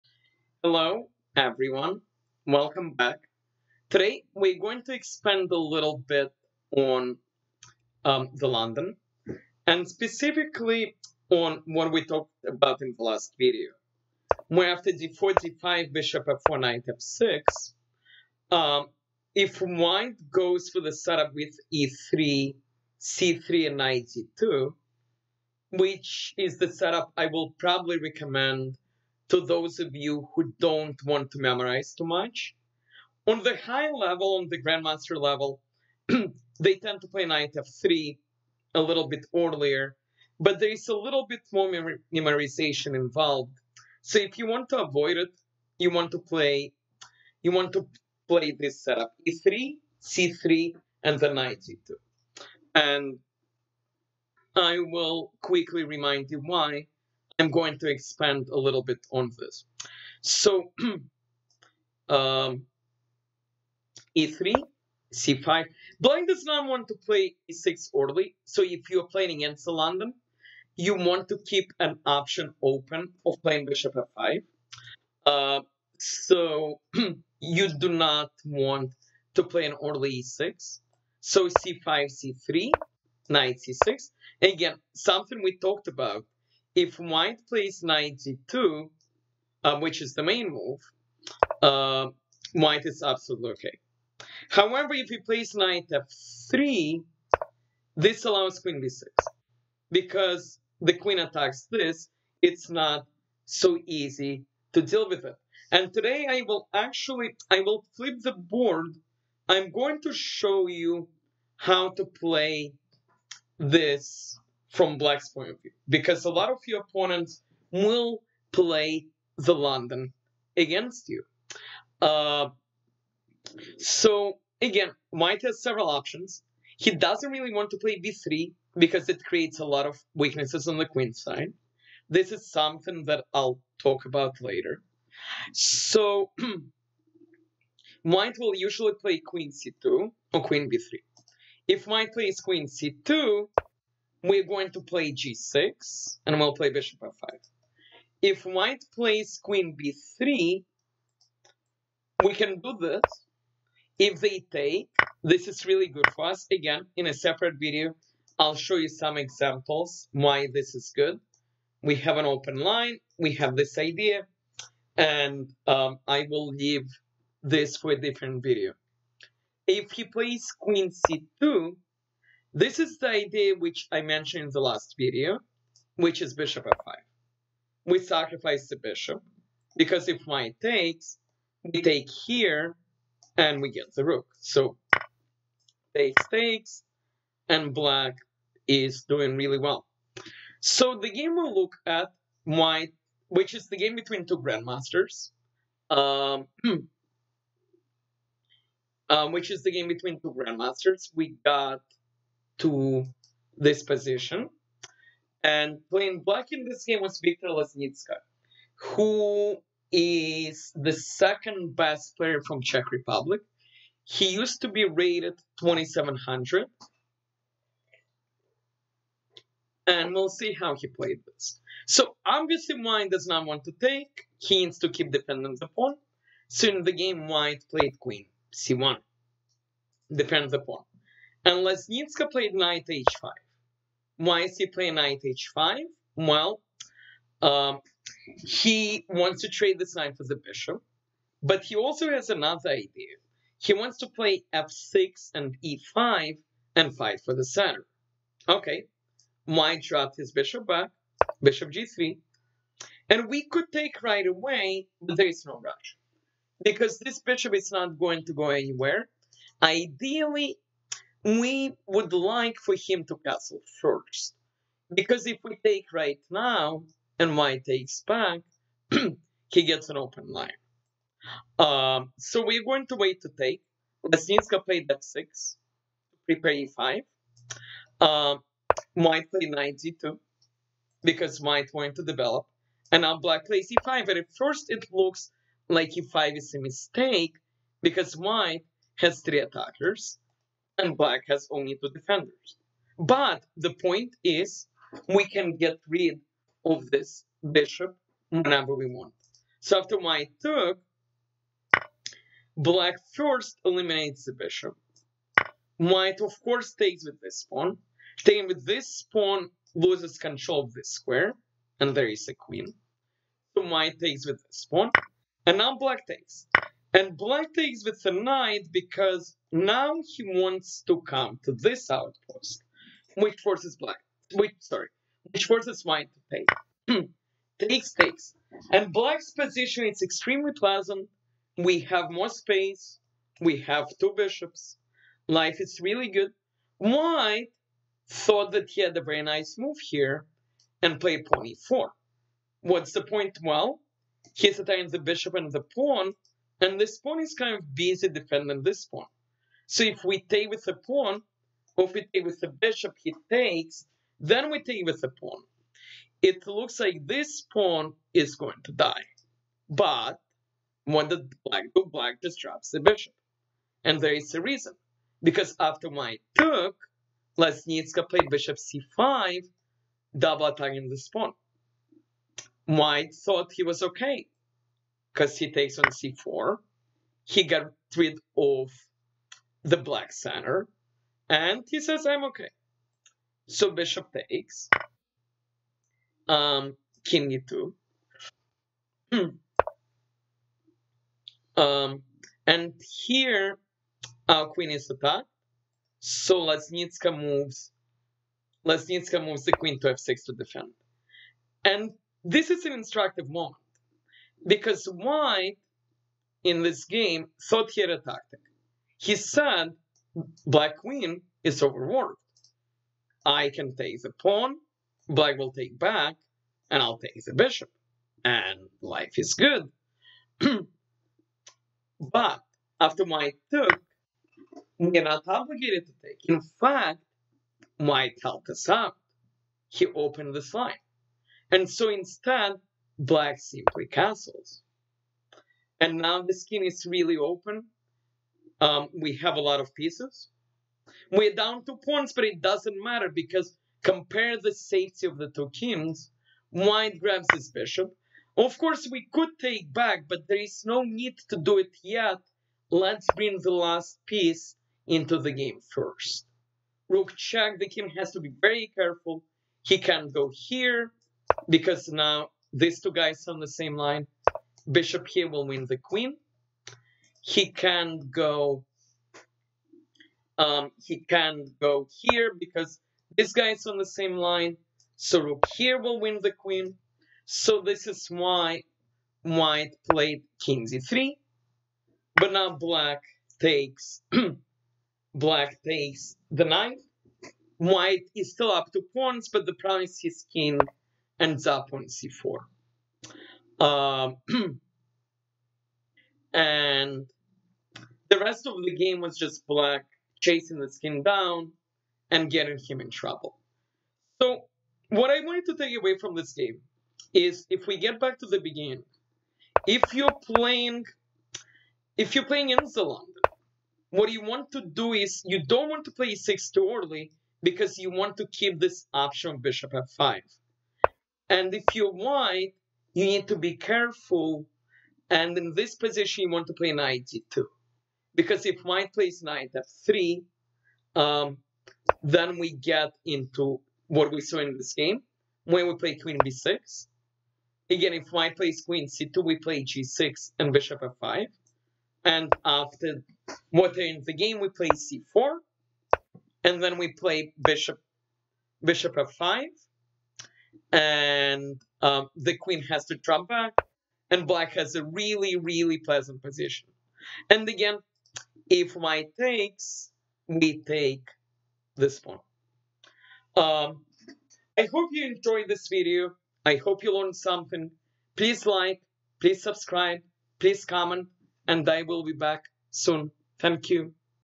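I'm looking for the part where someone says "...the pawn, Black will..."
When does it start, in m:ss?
6:54.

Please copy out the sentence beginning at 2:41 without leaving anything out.
We have an open line, we have this idea, and um, I will leave this for a different video.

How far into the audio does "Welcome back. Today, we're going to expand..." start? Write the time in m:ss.
0:02.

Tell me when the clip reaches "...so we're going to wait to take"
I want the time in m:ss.
4:32.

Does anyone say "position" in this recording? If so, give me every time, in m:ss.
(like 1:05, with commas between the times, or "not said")
3:23, 5:29, 8:45, 9:16.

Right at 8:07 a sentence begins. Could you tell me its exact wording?
White is still up to pawns, but the problem is his king ends up on c4.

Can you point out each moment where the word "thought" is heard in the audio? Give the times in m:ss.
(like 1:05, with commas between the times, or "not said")
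5:38, 6:13, 6:47.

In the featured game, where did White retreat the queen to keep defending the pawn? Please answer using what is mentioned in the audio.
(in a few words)
c1.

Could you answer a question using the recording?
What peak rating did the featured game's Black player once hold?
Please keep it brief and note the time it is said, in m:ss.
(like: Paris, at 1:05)
2700, at 3:35.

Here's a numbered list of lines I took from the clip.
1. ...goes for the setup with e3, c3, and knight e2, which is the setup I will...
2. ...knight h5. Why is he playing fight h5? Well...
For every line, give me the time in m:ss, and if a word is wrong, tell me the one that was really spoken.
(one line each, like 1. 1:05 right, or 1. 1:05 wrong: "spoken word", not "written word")
1. 0:20 right
2. 3:52 wrong: "knight", not "fight".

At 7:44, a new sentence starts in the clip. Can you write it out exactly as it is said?
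Bishop here will win the queen.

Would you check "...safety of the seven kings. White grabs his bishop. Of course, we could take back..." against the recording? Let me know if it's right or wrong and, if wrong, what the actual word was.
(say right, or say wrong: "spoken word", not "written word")
wrong: "two", not "seven".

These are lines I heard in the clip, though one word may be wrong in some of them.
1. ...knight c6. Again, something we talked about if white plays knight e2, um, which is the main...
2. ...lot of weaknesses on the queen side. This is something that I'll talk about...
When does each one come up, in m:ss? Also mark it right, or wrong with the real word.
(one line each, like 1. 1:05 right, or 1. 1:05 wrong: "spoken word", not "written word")
1. 1:23 right
2. 2:09 right.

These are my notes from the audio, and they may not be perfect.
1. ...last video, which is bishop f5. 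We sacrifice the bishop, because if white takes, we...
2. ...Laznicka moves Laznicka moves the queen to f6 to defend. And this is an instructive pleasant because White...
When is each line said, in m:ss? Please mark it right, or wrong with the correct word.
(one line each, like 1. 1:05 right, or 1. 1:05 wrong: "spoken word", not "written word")
1. 2:54 right
2. 6:36 wrong: "moment", not "pleasant".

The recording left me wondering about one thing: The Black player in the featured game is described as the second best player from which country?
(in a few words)
Czech Republic.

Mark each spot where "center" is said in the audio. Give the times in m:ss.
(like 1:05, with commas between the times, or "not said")
4:07, 6:20.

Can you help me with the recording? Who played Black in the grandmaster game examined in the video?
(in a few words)
Viktor Laznicka.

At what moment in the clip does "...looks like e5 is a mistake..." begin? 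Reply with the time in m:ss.
4:44.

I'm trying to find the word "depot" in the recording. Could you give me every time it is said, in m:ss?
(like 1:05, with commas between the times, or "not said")
not said.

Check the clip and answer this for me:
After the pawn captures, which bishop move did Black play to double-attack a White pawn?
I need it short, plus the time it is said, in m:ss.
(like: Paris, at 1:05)
Bishop c5, at 6:08.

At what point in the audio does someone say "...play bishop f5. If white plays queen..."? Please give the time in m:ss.
2:26.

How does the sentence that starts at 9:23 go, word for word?
Um, I hope you enjoyed this video.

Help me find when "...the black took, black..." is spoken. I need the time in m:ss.
6:01.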